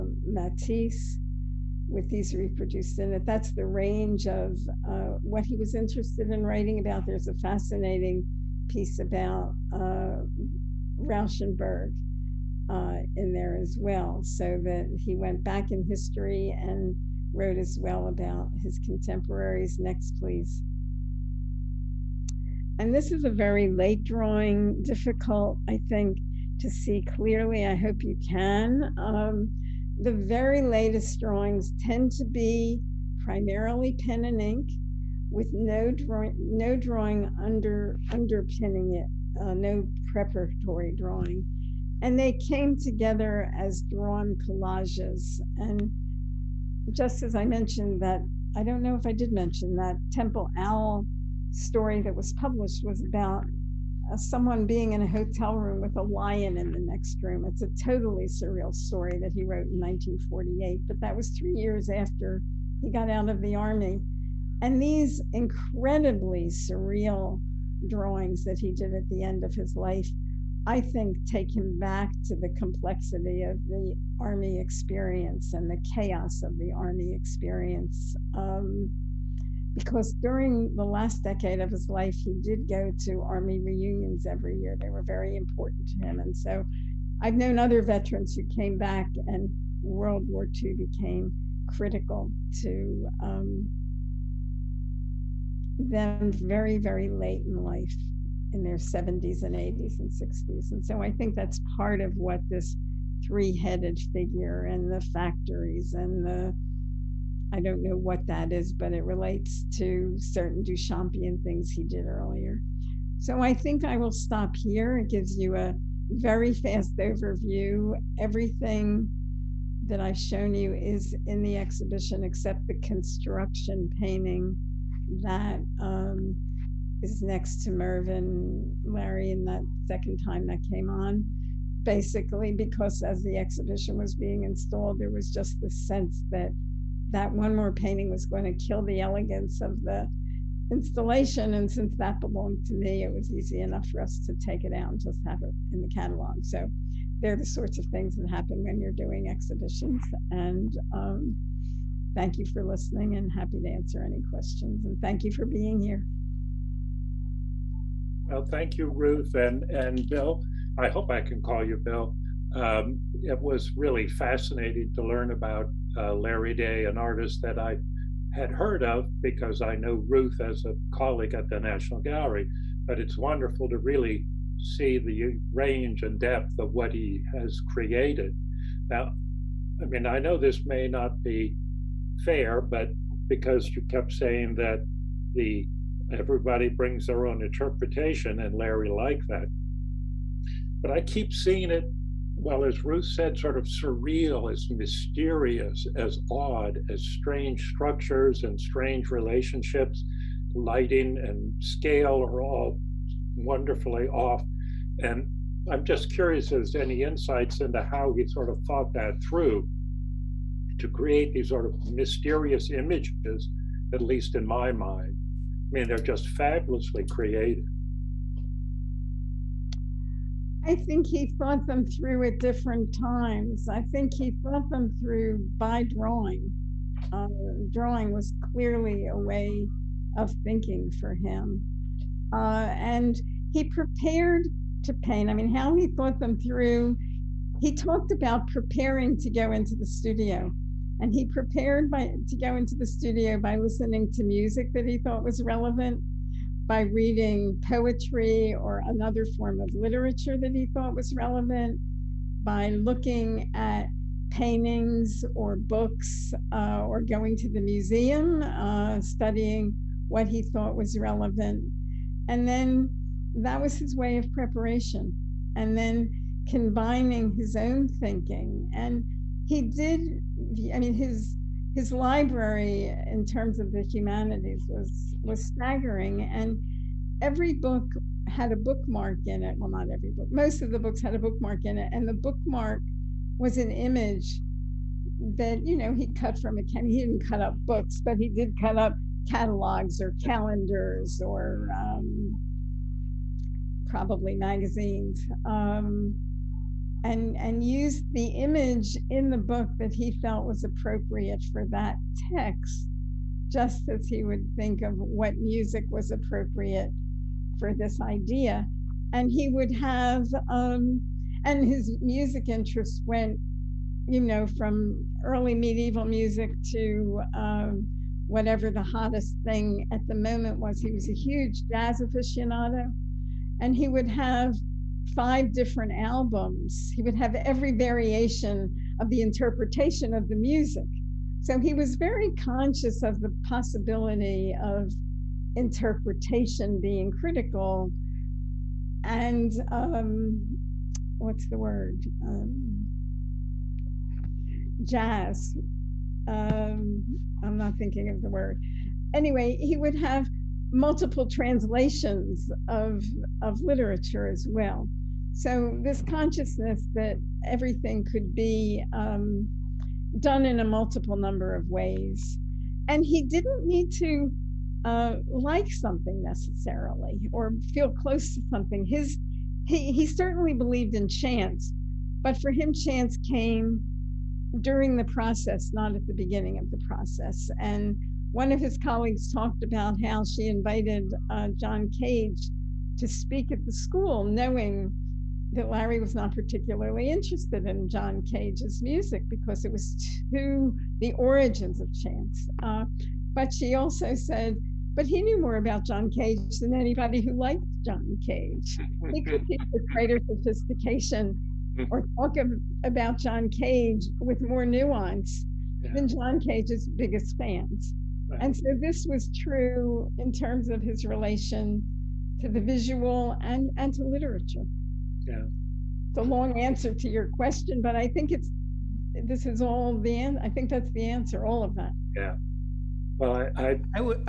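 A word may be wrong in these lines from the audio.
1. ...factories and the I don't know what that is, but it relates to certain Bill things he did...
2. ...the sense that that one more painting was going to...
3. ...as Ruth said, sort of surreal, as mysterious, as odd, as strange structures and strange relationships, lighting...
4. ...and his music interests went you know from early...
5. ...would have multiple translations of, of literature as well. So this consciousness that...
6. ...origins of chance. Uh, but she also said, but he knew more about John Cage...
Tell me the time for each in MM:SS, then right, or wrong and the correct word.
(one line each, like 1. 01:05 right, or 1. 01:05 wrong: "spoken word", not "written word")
1. 01:44 wrong: "Duchampian", not "Bill"
2. 02:15 right
3. 03:12 right
4. 05:11 right
5. 05:49 right
6. 06:31 right.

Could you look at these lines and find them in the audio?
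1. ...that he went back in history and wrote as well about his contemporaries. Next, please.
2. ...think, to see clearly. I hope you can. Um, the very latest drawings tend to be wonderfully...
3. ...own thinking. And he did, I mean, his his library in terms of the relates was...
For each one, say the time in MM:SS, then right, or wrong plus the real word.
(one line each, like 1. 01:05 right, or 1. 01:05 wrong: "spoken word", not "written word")
1. 00:14 right
2. 00:25 wrong: "primarily", not "wonderfully"
3. 04:27 wrong: "humanities", not "relates".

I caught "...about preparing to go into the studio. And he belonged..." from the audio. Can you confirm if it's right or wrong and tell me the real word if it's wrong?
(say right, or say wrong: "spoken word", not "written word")
wrong: "prepared", not "belonged".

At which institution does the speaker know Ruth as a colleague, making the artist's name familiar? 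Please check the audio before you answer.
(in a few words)
National Gallery.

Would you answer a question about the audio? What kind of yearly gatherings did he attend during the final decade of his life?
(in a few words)
Army reunions.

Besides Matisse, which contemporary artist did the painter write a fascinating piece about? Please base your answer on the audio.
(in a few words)
Rauschenberg.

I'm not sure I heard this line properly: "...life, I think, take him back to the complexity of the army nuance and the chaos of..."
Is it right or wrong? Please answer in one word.
wrong.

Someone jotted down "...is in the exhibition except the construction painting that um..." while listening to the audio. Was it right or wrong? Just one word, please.
right.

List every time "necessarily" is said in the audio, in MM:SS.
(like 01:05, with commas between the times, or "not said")
06:06.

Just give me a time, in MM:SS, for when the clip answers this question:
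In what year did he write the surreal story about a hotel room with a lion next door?
00:59.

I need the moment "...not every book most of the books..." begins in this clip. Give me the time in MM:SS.
04:39.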